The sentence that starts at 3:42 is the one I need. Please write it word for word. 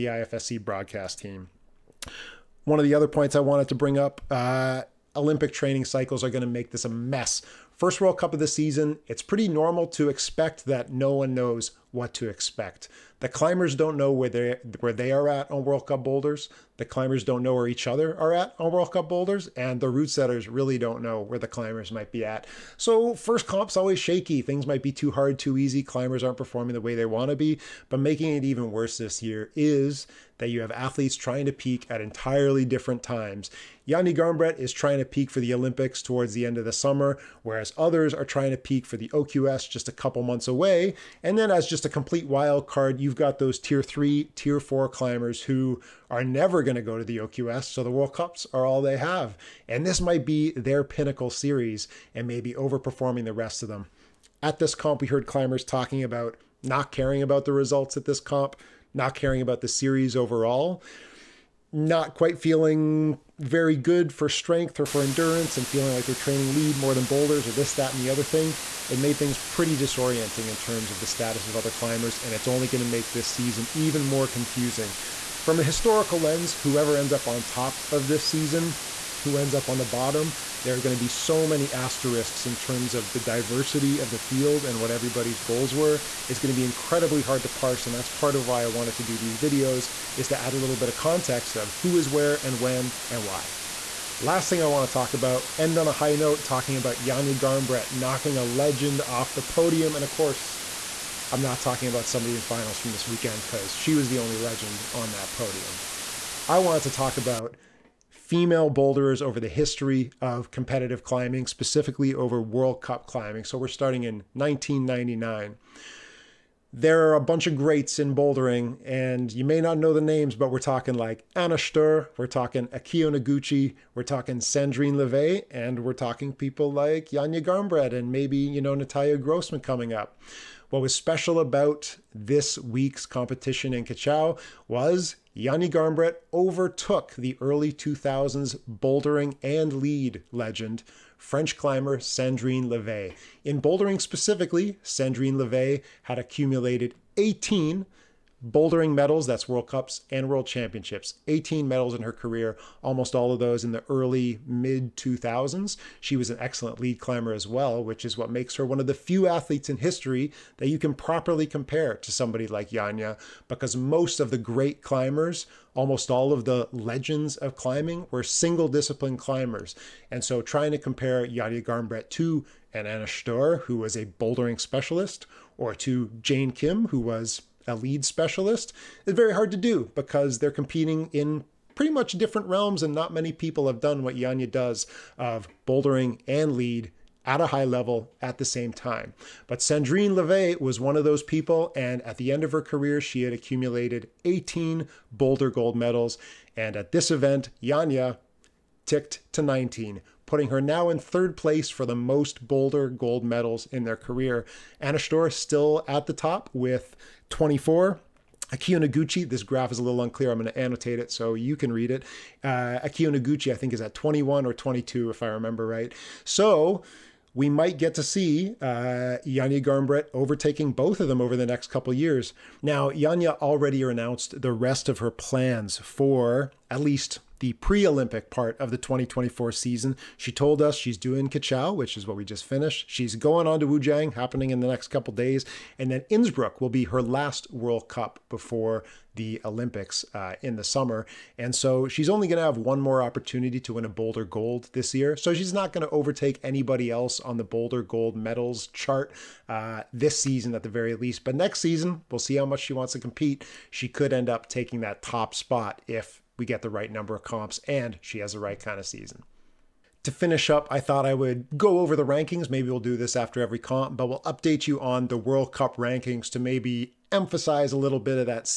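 Now, Janja already announced the rest of her plans for at least the pre Olympic part of the 2024 season.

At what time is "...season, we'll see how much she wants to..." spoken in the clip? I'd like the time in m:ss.
4:11.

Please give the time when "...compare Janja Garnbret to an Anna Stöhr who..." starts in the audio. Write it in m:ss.
2:50.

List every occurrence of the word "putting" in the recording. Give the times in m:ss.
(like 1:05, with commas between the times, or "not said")
3:20.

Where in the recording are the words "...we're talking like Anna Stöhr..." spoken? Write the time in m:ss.
2:00.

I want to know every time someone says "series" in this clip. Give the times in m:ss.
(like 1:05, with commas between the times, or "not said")
0:51, 0:59.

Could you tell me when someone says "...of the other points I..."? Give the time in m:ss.
0:02.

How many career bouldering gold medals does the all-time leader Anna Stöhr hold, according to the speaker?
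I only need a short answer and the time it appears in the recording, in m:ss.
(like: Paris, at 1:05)
24, at 3:27.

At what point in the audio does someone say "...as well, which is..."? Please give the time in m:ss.
2:37.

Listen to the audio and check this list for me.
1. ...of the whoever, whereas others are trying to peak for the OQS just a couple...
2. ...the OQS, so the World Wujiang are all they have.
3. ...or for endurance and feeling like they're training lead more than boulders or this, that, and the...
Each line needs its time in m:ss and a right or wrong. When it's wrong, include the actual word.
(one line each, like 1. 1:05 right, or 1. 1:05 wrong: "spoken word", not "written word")
1. 0:36 wrong: "summer", not "whoever"
2. 0:47 wrong: "Cups", not "Wujiang"
3. 1:04 right.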